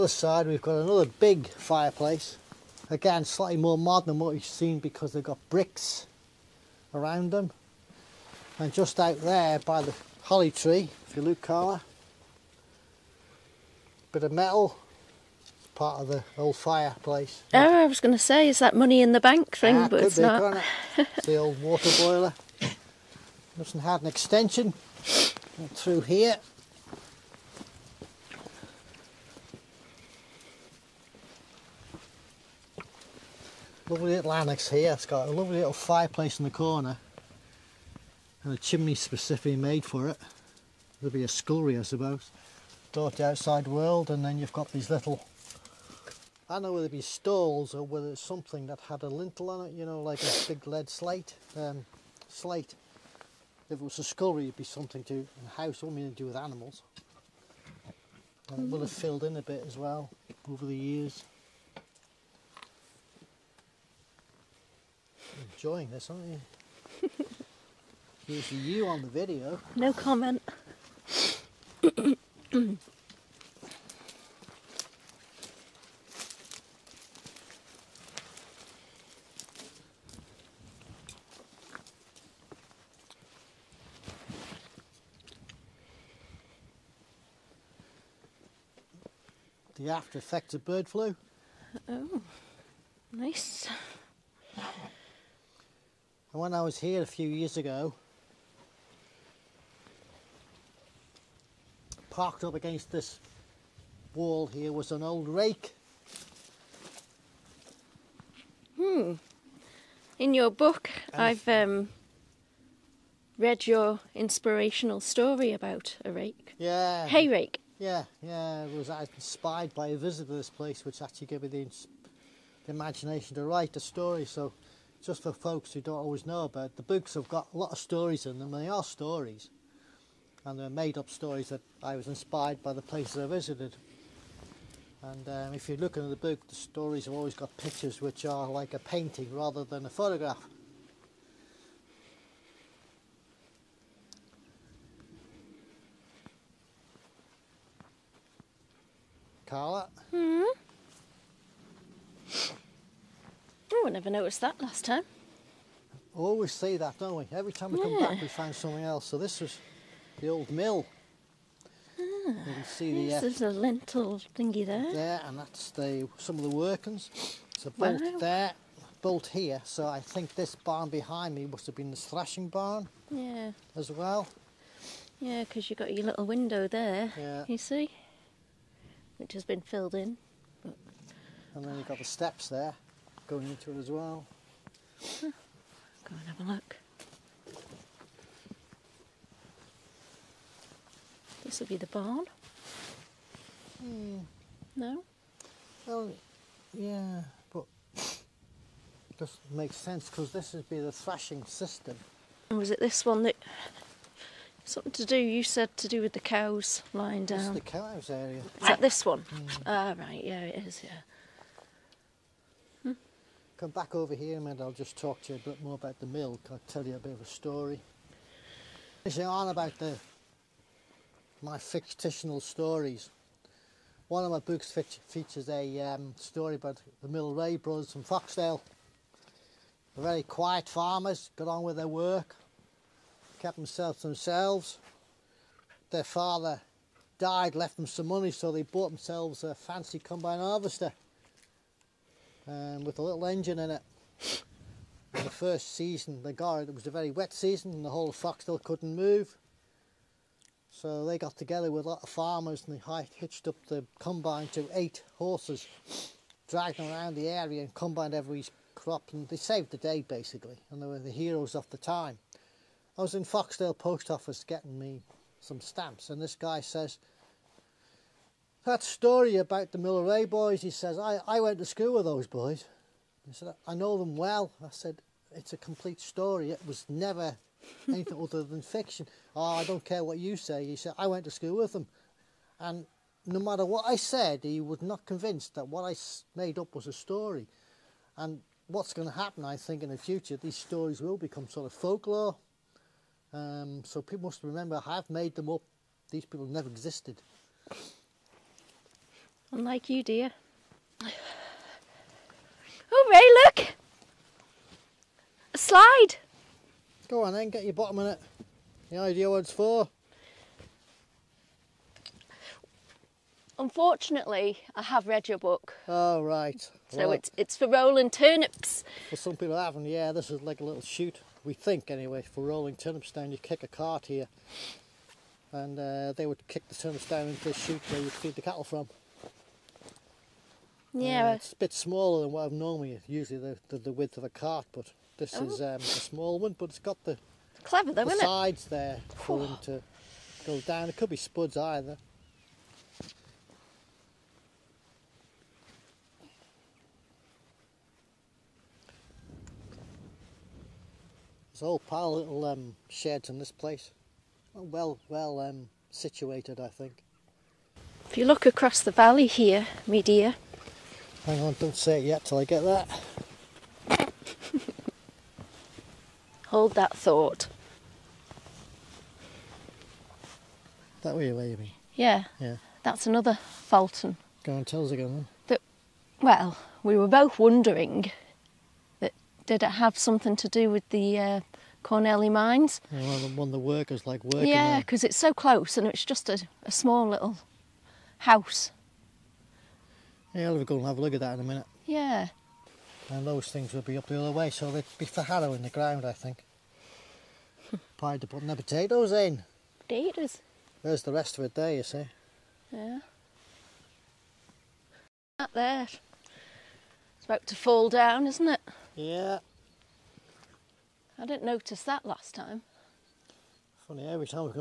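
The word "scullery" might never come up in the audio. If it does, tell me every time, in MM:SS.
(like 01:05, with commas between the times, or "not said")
00:41, 00:54.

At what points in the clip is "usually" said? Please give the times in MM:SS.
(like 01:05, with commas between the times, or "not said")
01:08, 05:33.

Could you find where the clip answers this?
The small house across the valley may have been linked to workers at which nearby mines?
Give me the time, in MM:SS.
06:21.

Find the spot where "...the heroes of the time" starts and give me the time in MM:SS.
04:20.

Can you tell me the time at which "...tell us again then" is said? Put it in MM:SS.
06:14.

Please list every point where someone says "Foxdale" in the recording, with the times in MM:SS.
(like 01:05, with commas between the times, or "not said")
03:48, 04:08, 04:23.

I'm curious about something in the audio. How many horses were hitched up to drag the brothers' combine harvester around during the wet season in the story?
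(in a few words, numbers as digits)
8.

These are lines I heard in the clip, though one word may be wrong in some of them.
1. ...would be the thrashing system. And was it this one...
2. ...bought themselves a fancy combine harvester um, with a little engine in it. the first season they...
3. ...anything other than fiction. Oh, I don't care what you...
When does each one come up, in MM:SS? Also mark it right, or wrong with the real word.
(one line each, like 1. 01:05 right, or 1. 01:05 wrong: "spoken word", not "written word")
1. 03:20 right
2. 03:58 right
3. 04:37 right.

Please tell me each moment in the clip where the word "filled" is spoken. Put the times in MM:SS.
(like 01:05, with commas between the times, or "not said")
00:58, 02:59.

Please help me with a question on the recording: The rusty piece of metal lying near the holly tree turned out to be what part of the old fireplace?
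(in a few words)
the old water boiler.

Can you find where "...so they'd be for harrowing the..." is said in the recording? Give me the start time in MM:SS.
06:34.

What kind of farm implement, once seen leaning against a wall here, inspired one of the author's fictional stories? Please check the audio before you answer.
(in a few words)
Hay rake.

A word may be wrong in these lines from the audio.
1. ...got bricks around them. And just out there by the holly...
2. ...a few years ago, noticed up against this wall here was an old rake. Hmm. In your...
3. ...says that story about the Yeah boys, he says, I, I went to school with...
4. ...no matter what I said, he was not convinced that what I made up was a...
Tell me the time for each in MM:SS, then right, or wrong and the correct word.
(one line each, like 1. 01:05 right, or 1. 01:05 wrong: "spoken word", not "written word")
1. 00:05 right
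2. 01:37 wrong: "parked", not "noticed"
3. 04:26 wrong: "Milleray", not "Yeah"
4. 04:43 right.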